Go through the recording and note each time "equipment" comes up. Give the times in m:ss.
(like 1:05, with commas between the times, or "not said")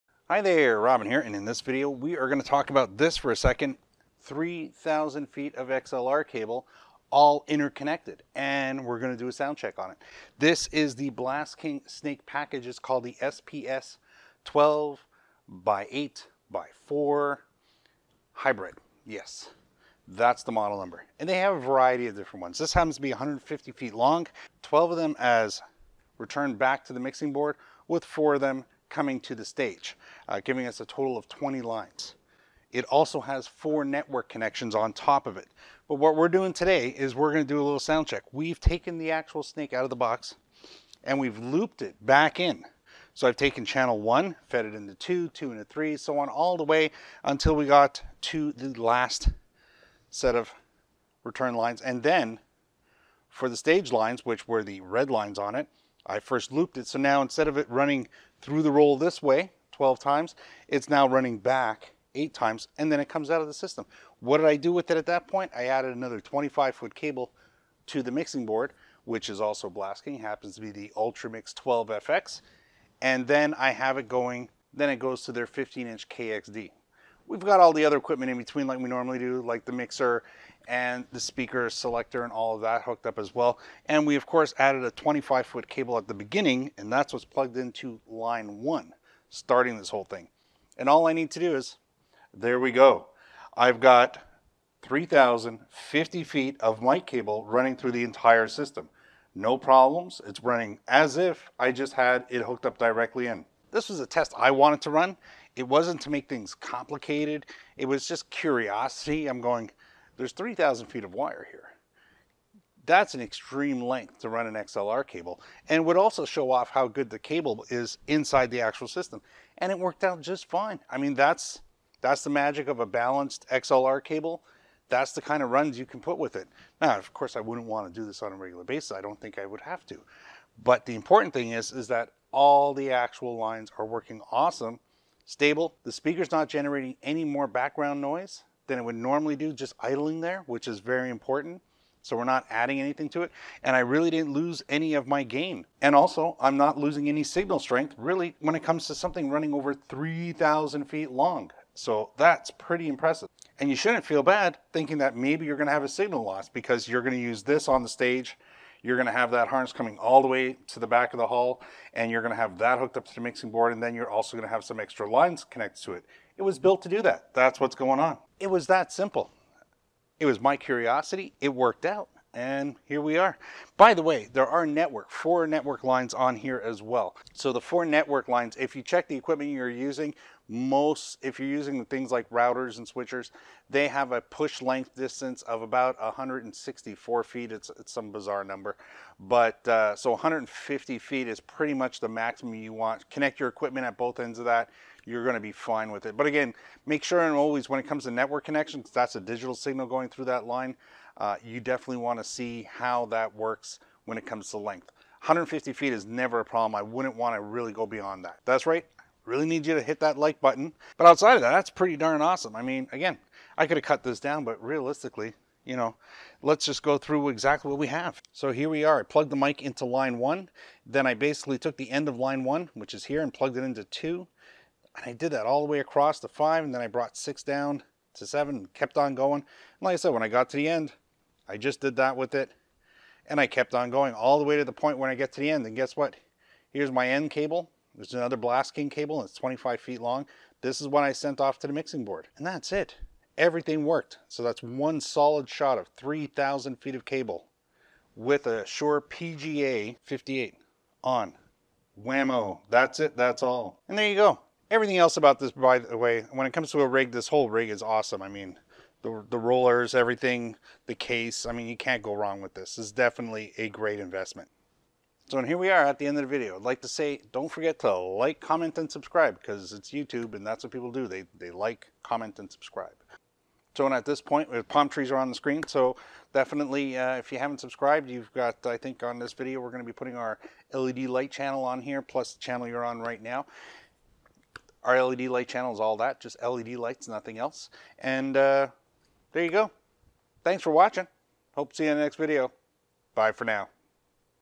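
1:17, 2:59, 3:13.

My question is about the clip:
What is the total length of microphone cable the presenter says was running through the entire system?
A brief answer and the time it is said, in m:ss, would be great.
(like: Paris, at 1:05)
3,050 feet, at 1:34.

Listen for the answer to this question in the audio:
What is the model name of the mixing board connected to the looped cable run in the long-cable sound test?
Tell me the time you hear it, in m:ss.
1:10.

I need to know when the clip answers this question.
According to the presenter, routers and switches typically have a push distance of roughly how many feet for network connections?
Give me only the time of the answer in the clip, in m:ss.
3:06.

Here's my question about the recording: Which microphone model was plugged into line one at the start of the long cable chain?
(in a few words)
Shure PGA 58.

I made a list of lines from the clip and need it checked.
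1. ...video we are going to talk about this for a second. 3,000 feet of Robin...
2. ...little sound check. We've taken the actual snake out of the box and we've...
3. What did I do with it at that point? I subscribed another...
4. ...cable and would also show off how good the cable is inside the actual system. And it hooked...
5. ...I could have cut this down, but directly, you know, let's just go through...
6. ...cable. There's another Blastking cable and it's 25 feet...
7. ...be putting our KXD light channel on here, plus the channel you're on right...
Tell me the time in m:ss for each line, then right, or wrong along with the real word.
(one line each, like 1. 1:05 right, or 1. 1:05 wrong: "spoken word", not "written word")
1. 0:01 wrong: "XLR", not "Robin"
2. 0:37 right
3. 1:04 wrong: "added", not "subscribed"
4. 1:55 wrong: "worked", not "hooked"
5. 3:33 wrong: "realistically", not "directly"
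6. 3:57 right
7. 4:39 wrong: "LED", not "KXD".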